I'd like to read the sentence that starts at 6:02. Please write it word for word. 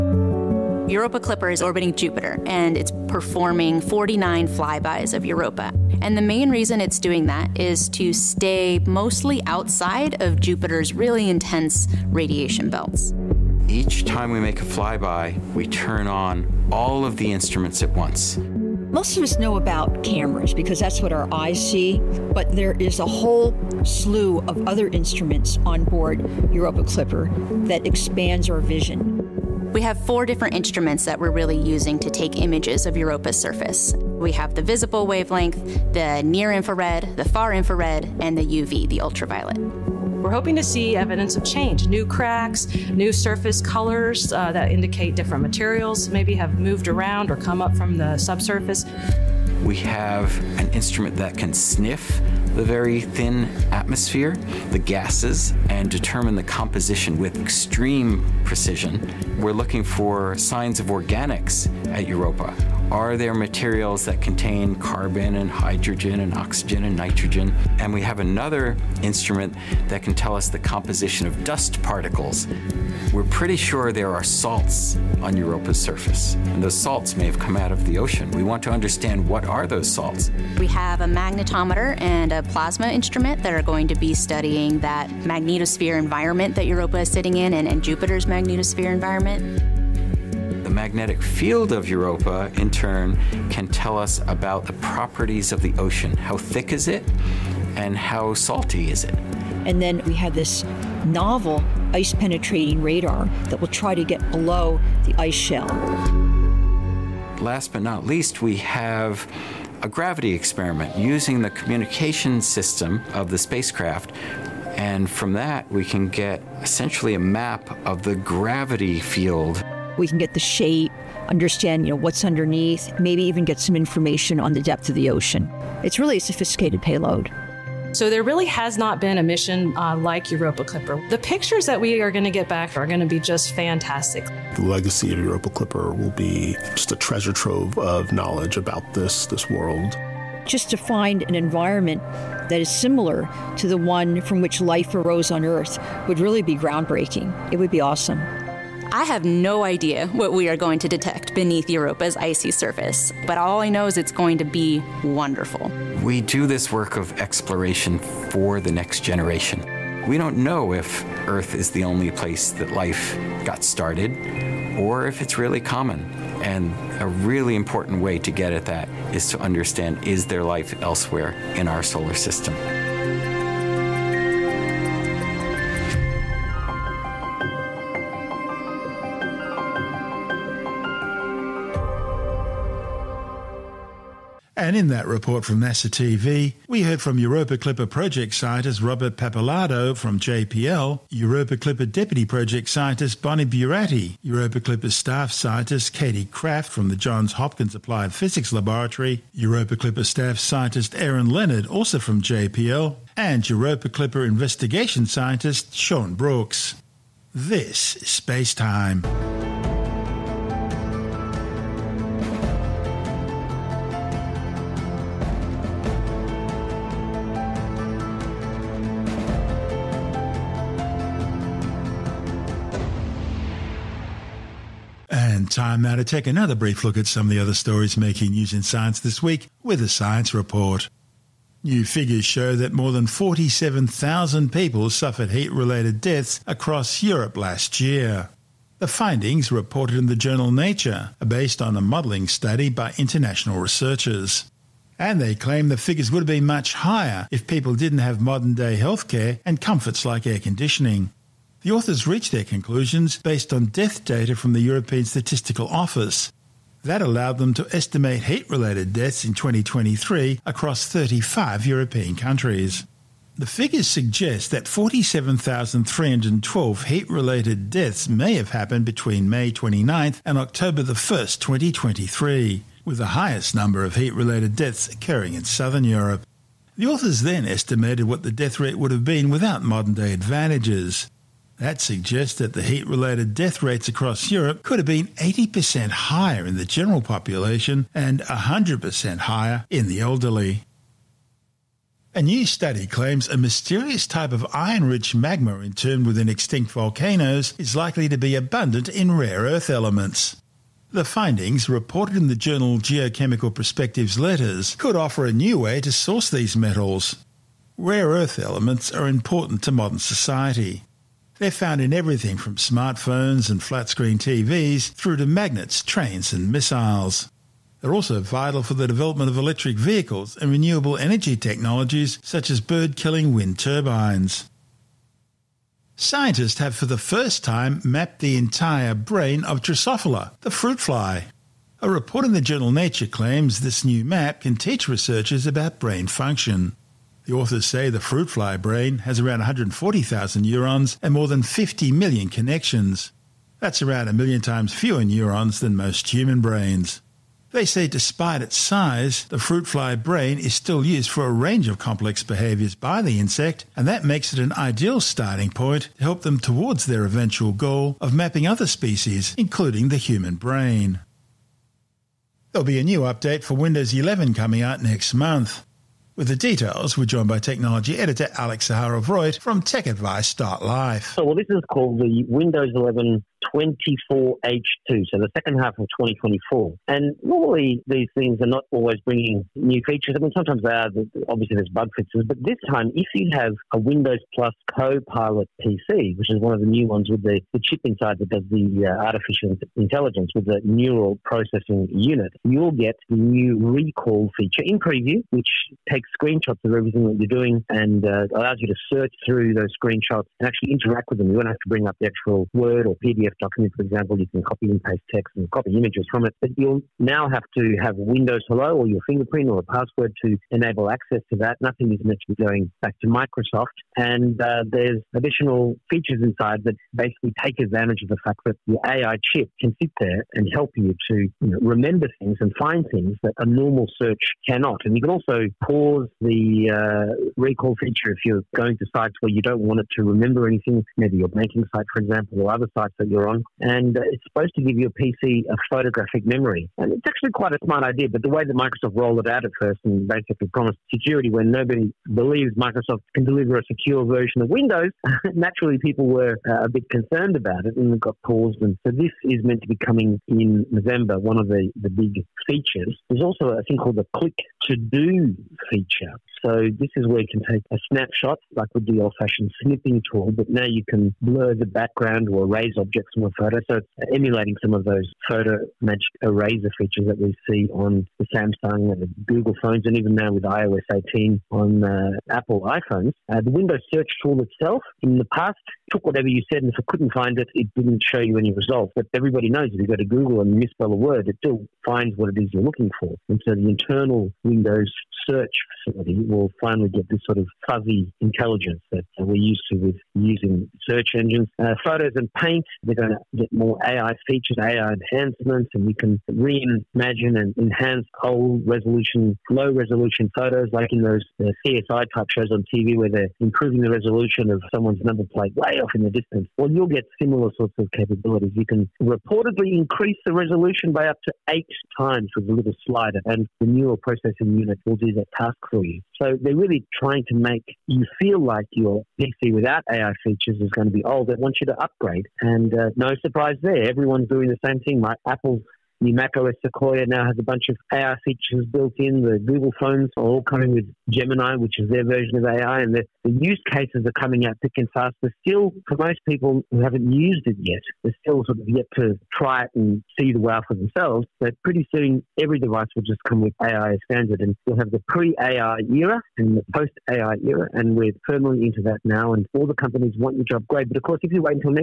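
There'll be a new update for Windows 11 coming out next month.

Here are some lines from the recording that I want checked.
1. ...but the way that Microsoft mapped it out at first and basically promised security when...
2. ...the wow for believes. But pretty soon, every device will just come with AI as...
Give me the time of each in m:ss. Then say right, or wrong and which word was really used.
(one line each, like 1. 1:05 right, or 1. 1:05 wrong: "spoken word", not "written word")
1. 7:18 wrong: "rolled", not "mapped"
2. 9:00 wrong: "themselves", not "believes".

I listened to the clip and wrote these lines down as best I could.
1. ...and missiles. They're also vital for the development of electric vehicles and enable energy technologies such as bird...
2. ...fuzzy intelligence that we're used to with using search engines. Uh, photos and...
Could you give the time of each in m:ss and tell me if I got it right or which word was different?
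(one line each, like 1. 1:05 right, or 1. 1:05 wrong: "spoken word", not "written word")
1. 5:16 wrong: "renewable", not "enable"
2. 8:07 right.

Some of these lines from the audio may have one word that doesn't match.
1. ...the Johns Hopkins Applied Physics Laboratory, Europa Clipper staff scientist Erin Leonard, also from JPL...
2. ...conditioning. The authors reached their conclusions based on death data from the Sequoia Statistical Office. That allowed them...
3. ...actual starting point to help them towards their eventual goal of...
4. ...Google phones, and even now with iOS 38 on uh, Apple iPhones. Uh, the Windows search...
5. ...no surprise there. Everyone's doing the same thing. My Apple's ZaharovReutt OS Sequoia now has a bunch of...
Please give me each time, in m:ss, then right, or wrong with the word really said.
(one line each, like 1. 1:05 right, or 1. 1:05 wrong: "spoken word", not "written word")
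1. 3:16 right
2. 4:10 wrong: "European", not "Sequoia"
3. 5:54 wrong: "ideal", not "actual"
4. 7:49 wrong: "18", not "38"
5. 8:42 wrong: "Mac", not "ZaharovReutt".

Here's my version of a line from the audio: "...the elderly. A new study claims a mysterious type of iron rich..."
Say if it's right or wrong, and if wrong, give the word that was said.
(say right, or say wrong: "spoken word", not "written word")
right.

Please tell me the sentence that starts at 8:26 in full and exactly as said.
Well, you'll get similar sorts of capabilities.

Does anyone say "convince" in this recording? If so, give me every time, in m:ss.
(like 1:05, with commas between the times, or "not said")
not said.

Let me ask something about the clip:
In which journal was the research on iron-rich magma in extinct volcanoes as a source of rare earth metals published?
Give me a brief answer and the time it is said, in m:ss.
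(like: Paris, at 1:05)
Geochemical Perspectives Letters, at 5:02.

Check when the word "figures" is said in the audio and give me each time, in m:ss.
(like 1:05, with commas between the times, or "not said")
3:51, 4:05, 4:23.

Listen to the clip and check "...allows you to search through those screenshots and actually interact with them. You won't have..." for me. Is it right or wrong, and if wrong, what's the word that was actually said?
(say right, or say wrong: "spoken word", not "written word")
right.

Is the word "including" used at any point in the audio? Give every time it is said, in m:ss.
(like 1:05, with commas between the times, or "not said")
5:59.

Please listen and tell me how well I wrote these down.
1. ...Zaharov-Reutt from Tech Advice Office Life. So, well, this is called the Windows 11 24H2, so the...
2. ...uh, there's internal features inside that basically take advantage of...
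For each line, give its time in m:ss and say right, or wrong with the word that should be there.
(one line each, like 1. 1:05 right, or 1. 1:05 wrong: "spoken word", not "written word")
1. 6:08 wrong: "Start", not "Office"
2. 6:54 wrong: "additional", not "internal".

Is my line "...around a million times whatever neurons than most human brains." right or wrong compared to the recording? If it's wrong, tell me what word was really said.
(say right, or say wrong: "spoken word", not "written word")
wrong: "fewer", not "whatever".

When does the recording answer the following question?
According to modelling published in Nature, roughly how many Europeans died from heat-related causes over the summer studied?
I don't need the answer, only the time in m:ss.
4:24.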